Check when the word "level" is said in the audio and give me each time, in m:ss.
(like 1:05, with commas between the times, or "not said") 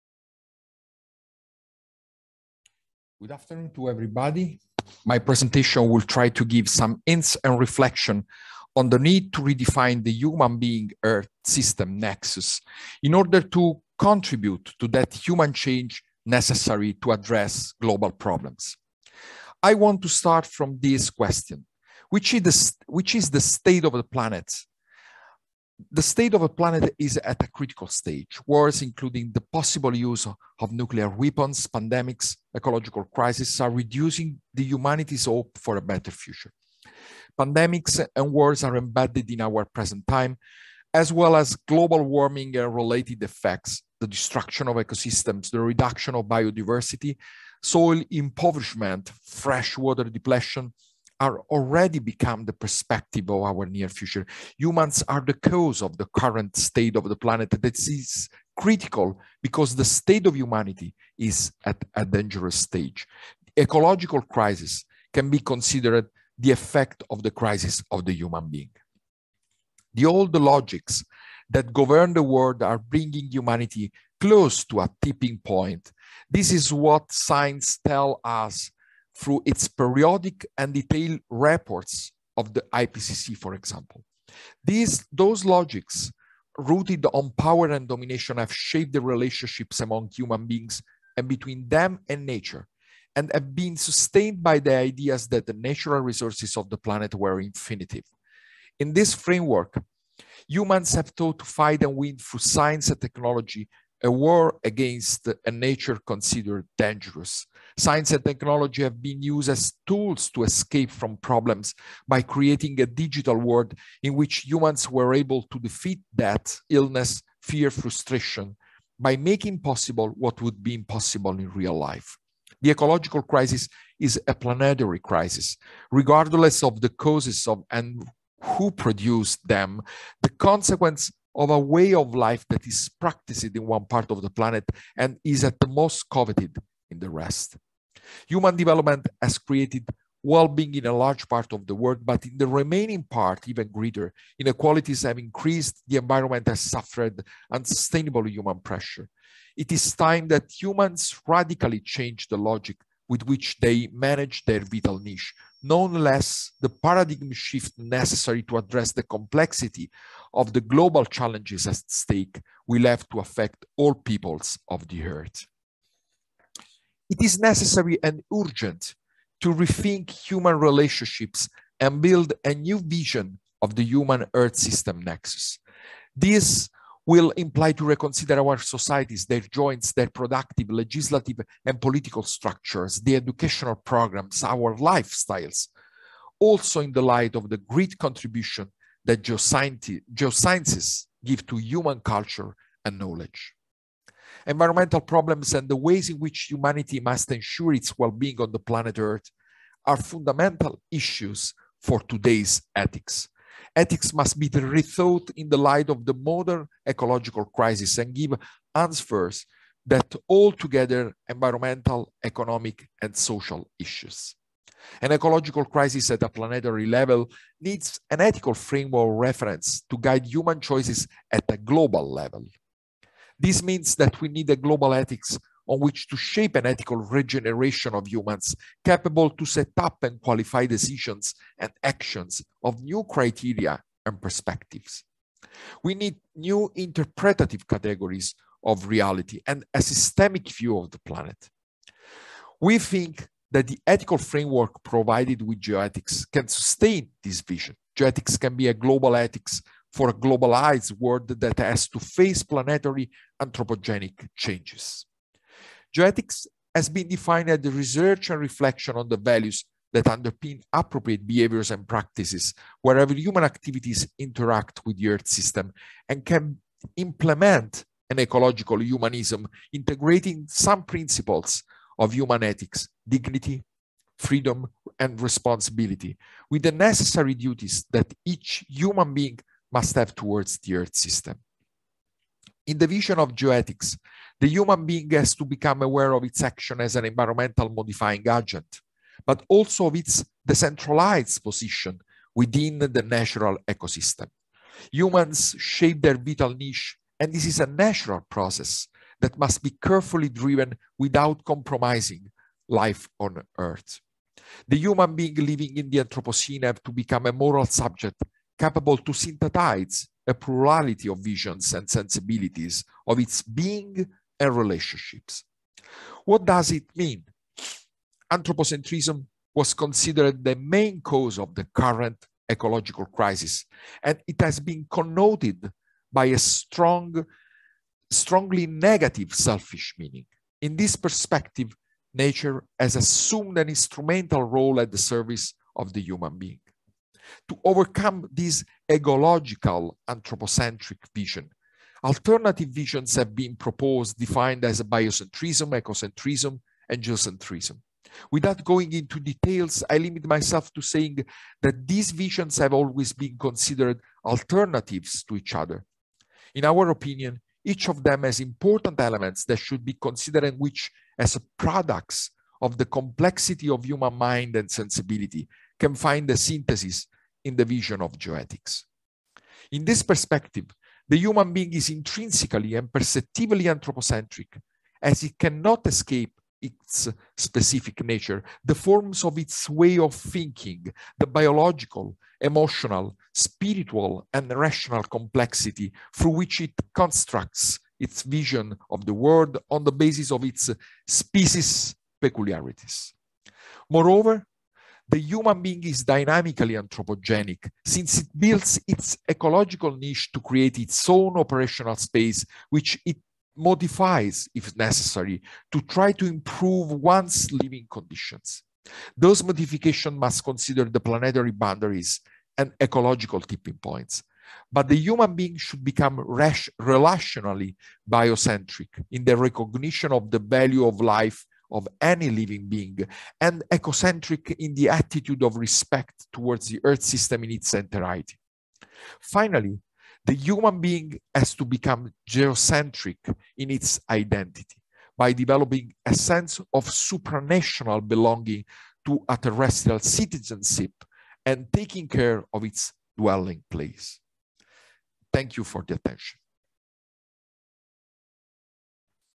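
3:36, 3:42.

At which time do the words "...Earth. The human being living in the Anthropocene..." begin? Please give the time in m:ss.
5:03.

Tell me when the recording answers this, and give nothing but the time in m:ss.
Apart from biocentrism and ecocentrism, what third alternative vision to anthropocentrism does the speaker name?
5:47.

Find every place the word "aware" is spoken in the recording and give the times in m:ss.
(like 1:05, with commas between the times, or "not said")
4:45.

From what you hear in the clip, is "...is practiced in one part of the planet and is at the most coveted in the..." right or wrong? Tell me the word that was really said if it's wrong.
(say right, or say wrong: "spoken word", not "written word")
right.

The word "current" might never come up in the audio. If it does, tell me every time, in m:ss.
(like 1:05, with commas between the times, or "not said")
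0:56, 5:21.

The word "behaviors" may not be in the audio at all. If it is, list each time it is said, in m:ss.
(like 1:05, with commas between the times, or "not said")
4:21.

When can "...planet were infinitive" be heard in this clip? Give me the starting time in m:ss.
1:36.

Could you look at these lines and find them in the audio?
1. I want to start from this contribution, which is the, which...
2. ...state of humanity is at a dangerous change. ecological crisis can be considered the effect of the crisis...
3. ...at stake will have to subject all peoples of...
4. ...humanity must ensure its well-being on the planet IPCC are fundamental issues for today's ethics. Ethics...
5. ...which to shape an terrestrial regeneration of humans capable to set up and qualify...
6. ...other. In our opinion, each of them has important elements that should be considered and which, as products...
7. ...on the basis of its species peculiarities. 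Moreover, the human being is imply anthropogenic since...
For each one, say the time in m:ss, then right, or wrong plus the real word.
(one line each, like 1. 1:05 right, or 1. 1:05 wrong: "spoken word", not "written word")
1. 0:19 wrong: "question", not "contribution"
2. 0:59 wrong: "stage", not "change"
3. 2:41 wrong: "affect", not "subject"
4. 3:16 wrong: "Earth", not "IPCC"
5. 3:45 wrong: "ethical", not "terrestrial"
6. 5:55 right
7. 6:29 wrong: "dynamically", not "imply".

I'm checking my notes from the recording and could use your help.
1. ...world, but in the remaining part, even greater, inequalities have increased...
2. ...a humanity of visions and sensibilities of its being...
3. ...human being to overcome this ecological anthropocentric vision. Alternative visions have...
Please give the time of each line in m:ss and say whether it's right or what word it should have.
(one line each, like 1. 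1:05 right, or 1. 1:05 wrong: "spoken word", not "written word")
1. 2:21 right
2. 5:10 wrong: "plurality", not "humanity"
3. 5:36 right.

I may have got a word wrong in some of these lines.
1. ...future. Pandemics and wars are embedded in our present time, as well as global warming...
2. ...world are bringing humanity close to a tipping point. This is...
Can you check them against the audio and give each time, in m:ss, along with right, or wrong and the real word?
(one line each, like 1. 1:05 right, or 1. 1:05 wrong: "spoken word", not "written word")
1. 0:36 right
2. 1:12 right.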